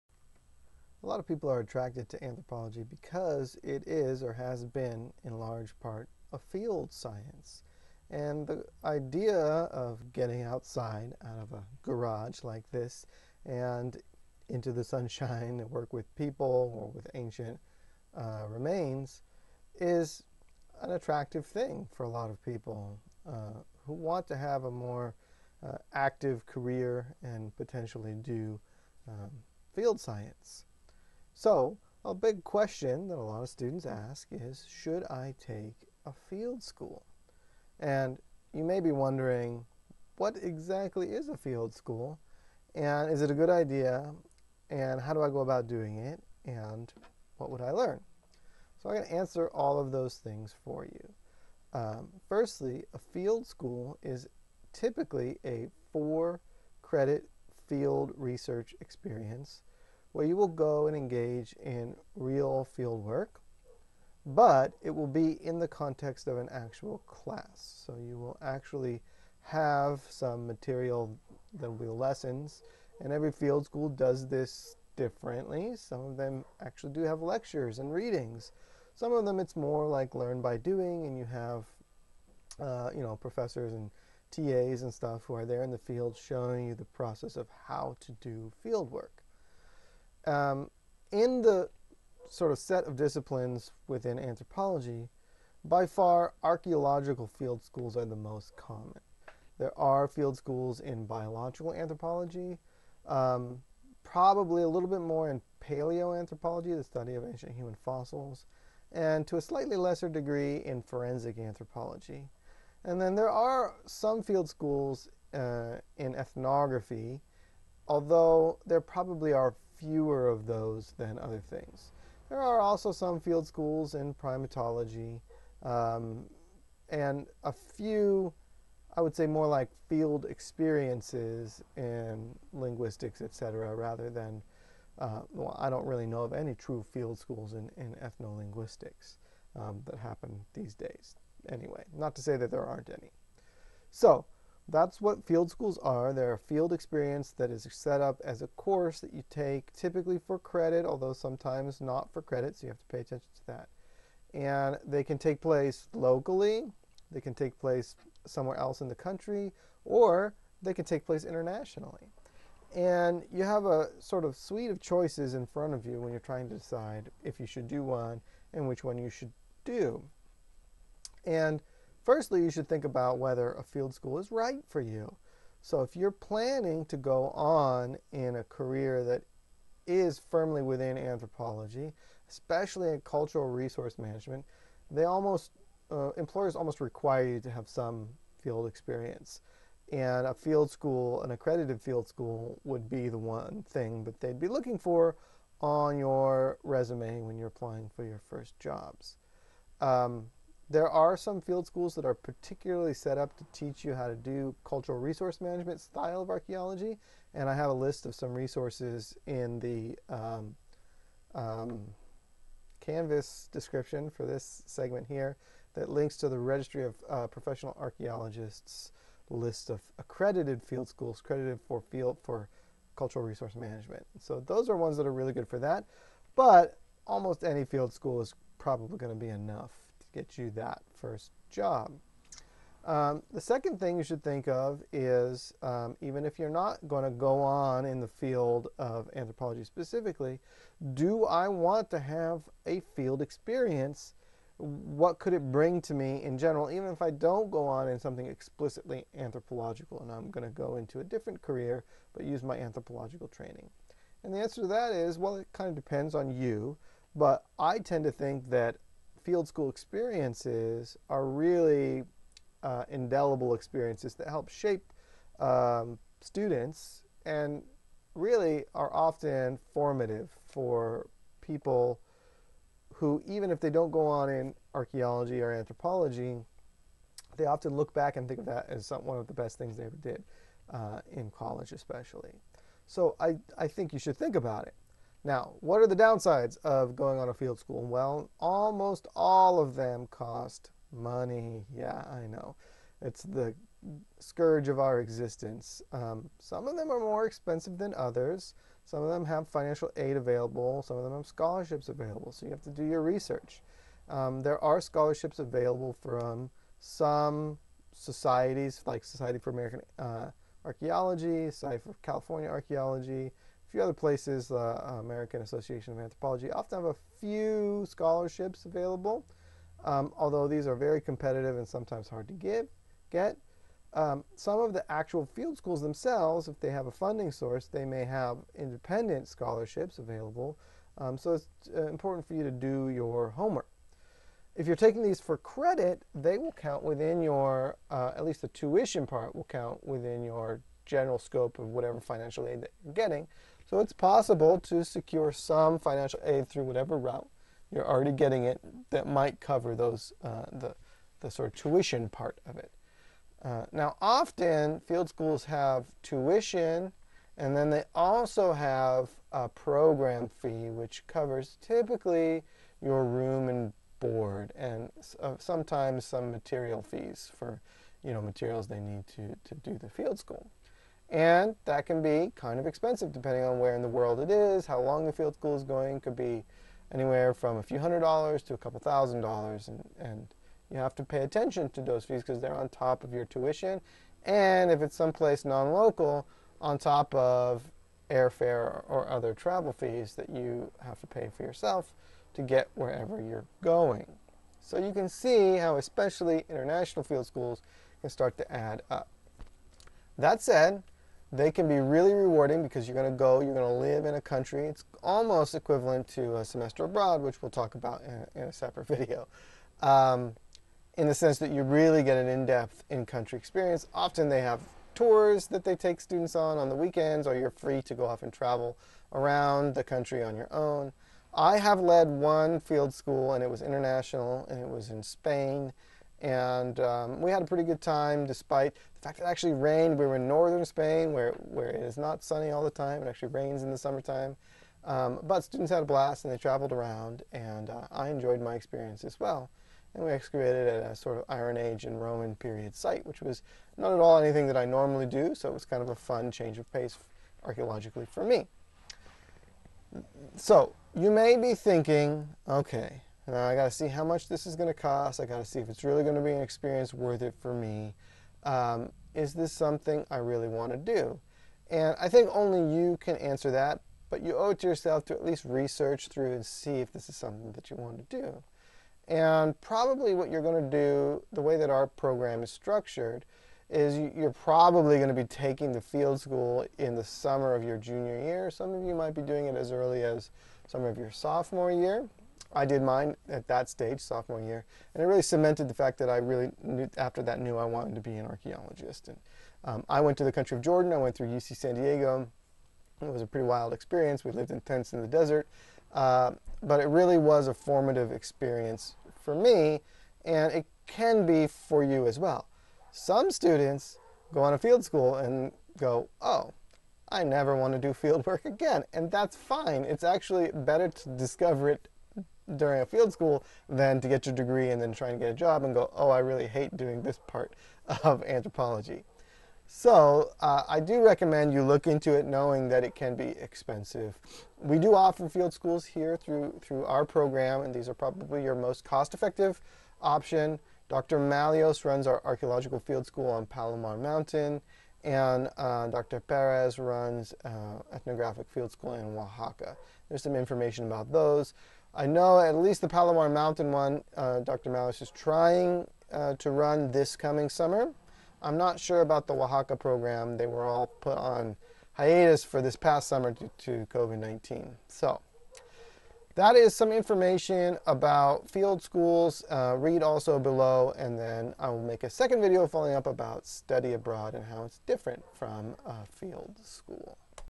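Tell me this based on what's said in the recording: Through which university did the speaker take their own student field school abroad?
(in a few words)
UC San Diego.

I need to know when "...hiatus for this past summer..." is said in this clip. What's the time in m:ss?
9:11.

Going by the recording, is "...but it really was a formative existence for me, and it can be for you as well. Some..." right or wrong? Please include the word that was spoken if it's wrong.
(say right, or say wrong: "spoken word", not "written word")
wrong: "experience", not "existence".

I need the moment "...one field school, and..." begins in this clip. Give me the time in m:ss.
7:02.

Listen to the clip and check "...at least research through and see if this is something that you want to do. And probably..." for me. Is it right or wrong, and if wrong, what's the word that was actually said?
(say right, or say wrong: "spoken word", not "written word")
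right.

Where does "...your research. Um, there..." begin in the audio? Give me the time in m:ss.
5:02.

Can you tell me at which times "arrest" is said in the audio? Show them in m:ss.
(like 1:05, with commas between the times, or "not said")
not said.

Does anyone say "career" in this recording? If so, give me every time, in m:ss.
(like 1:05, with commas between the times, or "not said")
0:26, 2:58, 4:11.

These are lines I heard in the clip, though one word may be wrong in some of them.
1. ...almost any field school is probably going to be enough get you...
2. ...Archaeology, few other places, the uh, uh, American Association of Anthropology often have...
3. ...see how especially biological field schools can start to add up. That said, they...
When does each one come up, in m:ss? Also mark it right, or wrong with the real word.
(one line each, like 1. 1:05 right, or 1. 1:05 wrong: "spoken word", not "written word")
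1. 3:47 right
2. 5:12 right
3. 6:35 wrong: "international", not "biological".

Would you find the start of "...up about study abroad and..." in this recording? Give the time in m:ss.
9:22.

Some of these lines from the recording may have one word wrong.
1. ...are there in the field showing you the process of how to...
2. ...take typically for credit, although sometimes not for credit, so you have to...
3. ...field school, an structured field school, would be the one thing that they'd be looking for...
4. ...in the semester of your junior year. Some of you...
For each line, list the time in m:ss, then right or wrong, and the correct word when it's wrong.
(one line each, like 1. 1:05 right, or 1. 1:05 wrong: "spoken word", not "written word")
1. 1:25 right
2. 2:29 right
3. 3:10 wrong: "accredited", not "structured"
4. 7:56 wrong: "summer", not "semester".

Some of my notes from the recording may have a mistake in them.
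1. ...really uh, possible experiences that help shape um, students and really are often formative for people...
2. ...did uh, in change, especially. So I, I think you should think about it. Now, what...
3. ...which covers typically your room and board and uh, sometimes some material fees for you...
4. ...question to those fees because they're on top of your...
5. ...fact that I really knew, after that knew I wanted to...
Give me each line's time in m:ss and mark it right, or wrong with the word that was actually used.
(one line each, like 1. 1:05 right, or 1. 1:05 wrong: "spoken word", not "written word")
1. 4:21 wrong: "indelible", not "possible"
2. 4:40 wrong: "college", not "change"
3. 6:00 right
4. 6:21 wrong: "attention", not "question"
5. 8:05 right.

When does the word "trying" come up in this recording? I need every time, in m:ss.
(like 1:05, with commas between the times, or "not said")
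2:46, 9:05.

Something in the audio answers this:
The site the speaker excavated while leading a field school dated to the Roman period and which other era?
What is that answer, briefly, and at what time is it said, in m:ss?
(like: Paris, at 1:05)
Iron Age, at 7:21.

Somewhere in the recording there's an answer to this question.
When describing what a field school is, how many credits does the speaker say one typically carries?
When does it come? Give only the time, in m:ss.
0:55.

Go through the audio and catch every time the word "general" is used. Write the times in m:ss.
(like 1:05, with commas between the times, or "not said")
4:06, 5:40.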